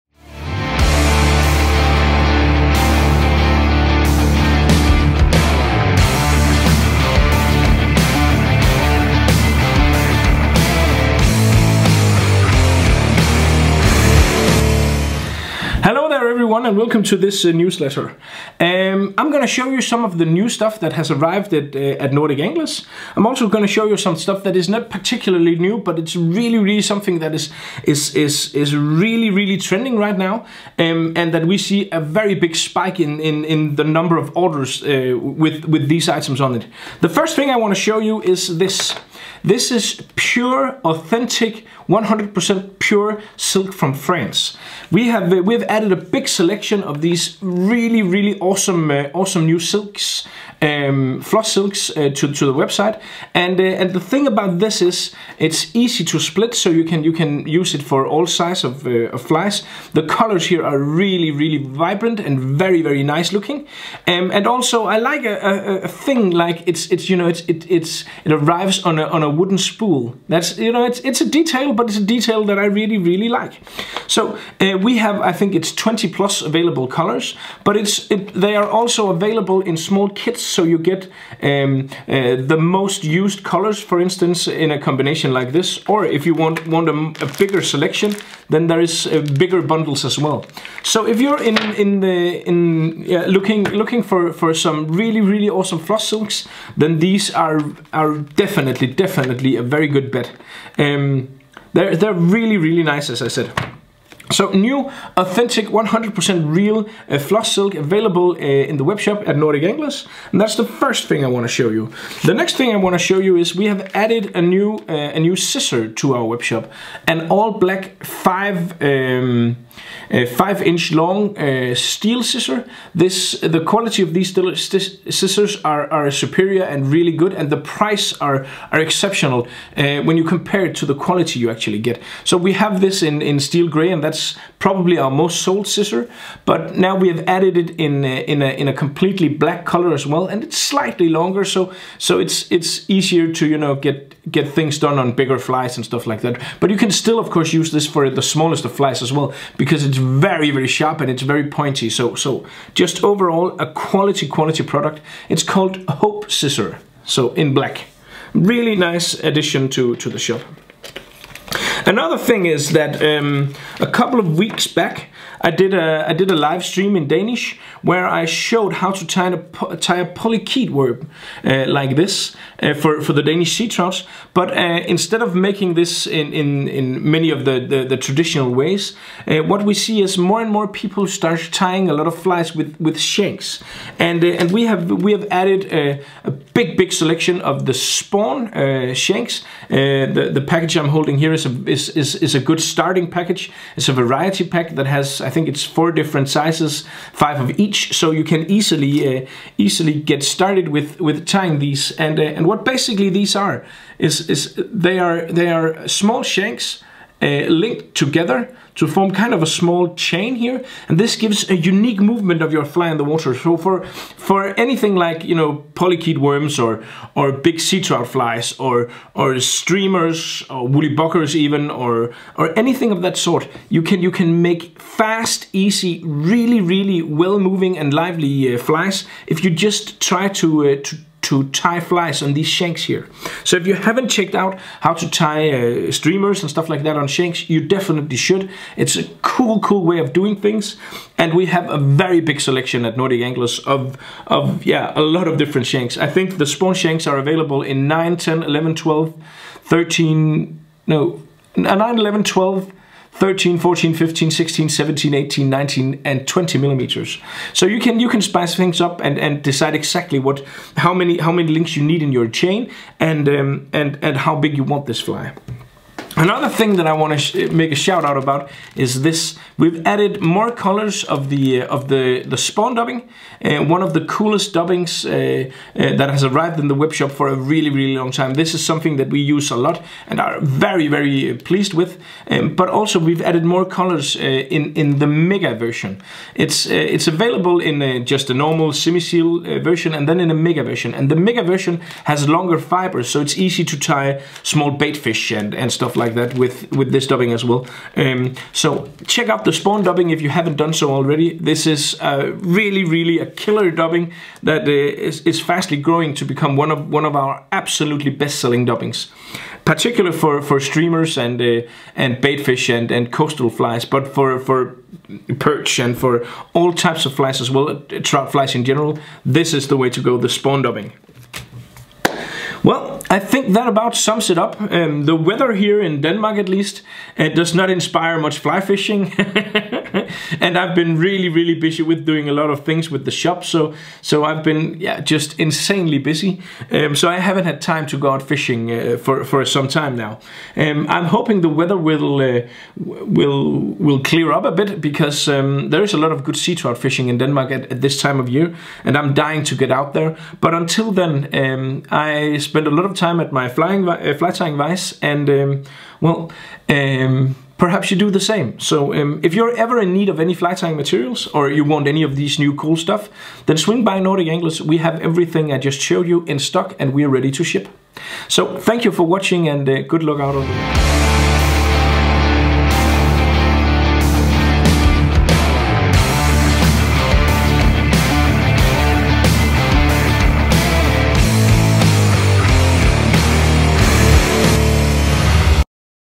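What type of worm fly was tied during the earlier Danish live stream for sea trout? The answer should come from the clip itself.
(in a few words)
Polychaete worm.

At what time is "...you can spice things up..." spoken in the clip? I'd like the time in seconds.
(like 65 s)
257 s.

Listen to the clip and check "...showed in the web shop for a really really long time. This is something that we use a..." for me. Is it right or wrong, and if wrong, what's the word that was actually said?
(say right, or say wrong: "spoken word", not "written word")
wrong: "arrived", not "showed".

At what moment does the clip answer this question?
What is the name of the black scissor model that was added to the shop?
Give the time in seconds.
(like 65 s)
155 s.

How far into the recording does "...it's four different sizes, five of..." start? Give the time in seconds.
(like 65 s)
195 s.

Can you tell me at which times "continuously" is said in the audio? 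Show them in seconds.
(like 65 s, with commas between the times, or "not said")
not said.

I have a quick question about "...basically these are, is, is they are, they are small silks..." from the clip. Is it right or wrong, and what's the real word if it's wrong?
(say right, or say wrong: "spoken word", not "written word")
wrong: "shanks", not "silks".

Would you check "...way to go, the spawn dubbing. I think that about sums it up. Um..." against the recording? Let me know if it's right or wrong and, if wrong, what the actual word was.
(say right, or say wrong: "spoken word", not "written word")
right.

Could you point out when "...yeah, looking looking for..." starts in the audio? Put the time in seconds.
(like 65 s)
93 s.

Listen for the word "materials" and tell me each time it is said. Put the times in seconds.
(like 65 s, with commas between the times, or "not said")
360 s.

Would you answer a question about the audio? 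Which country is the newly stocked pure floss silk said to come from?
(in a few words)
France.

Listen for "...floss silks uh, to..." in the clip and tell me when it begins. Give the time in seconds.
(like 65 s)
51 s.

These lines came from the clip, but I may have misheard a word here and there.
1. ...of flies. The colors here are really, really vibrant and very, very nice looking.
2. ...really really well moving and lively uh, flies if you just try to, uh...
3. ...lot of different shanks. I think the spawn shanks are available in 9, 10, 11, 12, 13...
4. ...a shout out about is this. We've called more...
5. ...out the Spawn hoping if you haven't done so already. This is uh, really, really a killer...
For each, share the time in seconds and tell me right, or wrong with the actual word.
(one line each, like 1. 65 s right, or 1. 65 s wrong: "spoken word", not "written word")
1. 59 s right
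2. 226 s right
3. 245 s right
4. 267 s wrong: "added", not "called"
5. 299 s wrong: "dubbing", not "hoping".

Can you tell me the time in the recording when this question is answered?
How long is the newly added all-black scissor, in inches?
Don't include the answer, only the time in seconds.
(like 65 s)
120 s.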